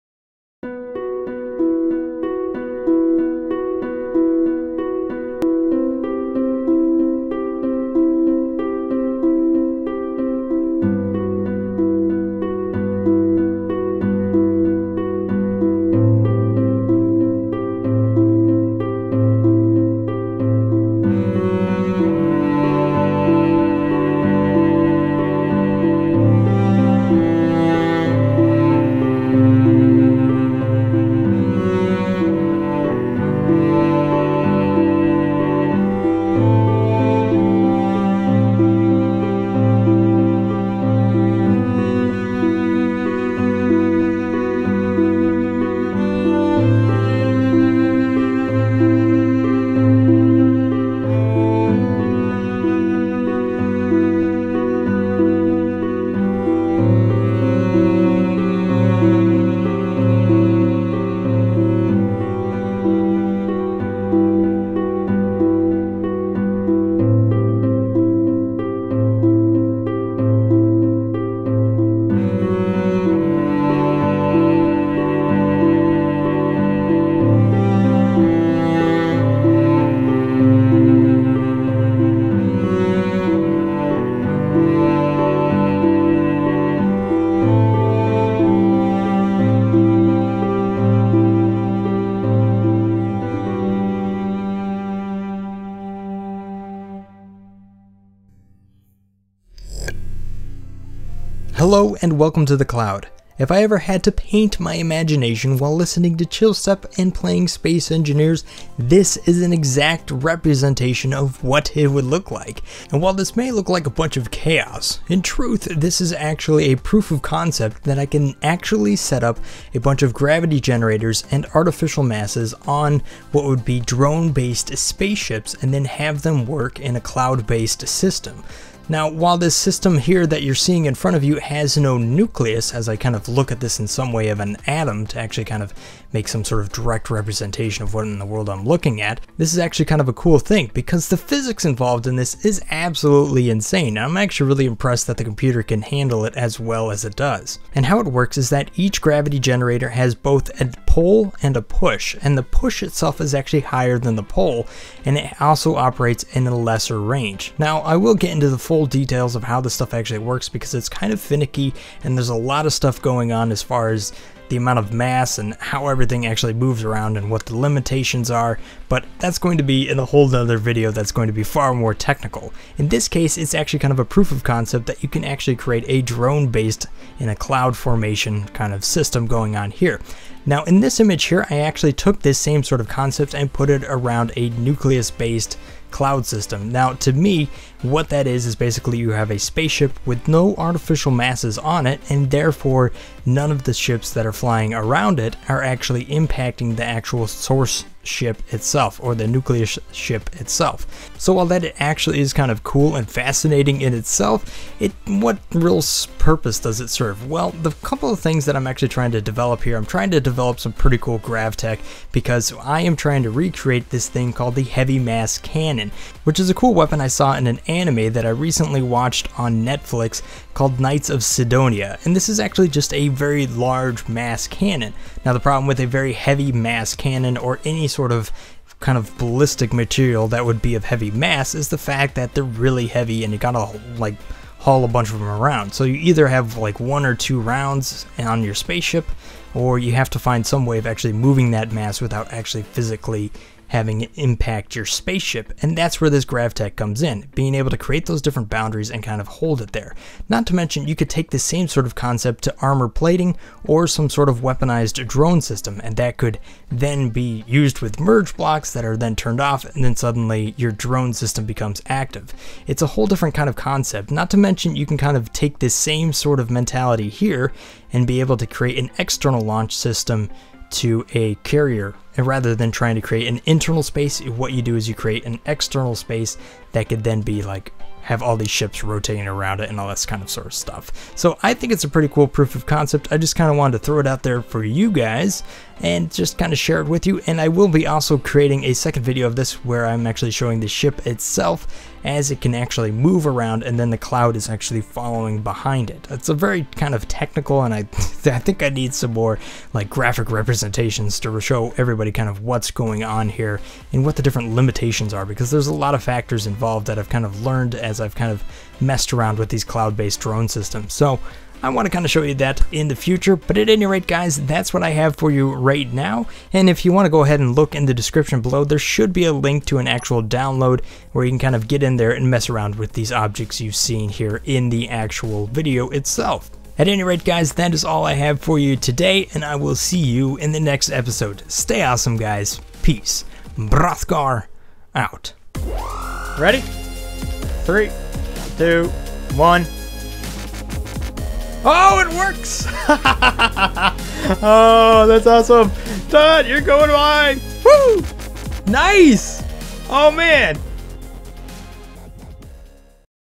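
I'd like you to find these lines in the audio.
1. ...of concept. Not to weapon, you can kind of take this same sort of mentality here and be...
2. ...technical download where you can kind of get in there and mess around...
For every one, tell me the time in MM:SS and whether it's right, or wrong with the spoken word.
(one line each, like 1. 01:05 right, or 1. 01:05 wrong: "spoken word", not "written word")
1. 04:23 wrong: "mention", not "weapon"
2. 05:19 wrong: "actual", not "technical".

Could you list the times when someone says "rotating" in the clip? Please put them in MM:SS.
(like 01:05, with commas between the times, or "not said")
04:38.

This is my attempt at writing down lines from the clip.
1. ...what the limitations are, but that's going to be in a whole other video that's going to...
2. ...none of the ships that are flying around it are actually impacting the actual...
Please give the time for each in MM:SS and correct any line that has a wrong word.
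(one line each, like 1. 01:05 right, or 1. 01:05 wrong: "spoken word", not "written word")
1. 02:47 right
2. 03:13 right.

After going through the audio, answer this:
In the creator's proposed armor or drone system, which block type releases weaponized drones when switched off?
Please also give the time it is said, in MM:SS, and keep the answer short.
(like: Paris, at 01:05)
merge blocks, at 04:17.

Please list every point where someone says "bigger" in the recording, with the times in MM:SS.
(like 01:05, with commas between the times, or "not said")
not said.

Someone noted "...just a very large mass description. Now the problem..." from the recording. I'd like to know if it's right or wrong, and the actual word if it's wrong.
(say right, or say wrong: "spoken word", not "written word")
wrong: "cannon", not "description".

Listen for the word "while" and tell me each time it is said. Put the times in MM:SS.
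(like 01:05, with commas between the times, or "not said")
01:45, 01:52, 02:09, 03:21.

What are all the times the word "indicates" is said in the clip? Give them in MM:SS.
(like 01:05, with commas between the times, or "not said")
not said.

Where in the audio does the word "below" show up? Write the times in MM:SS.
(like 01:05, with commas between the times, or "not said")
05:18.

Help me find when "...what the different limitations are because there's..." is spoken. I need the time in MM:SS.
05:04.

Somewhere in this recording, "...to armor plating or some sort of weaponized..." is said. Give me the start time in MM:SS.
04:12.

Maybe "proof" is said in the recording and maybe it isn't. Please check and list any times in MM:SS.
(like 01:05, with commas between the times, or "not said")
01:56, 02:54, 04:42.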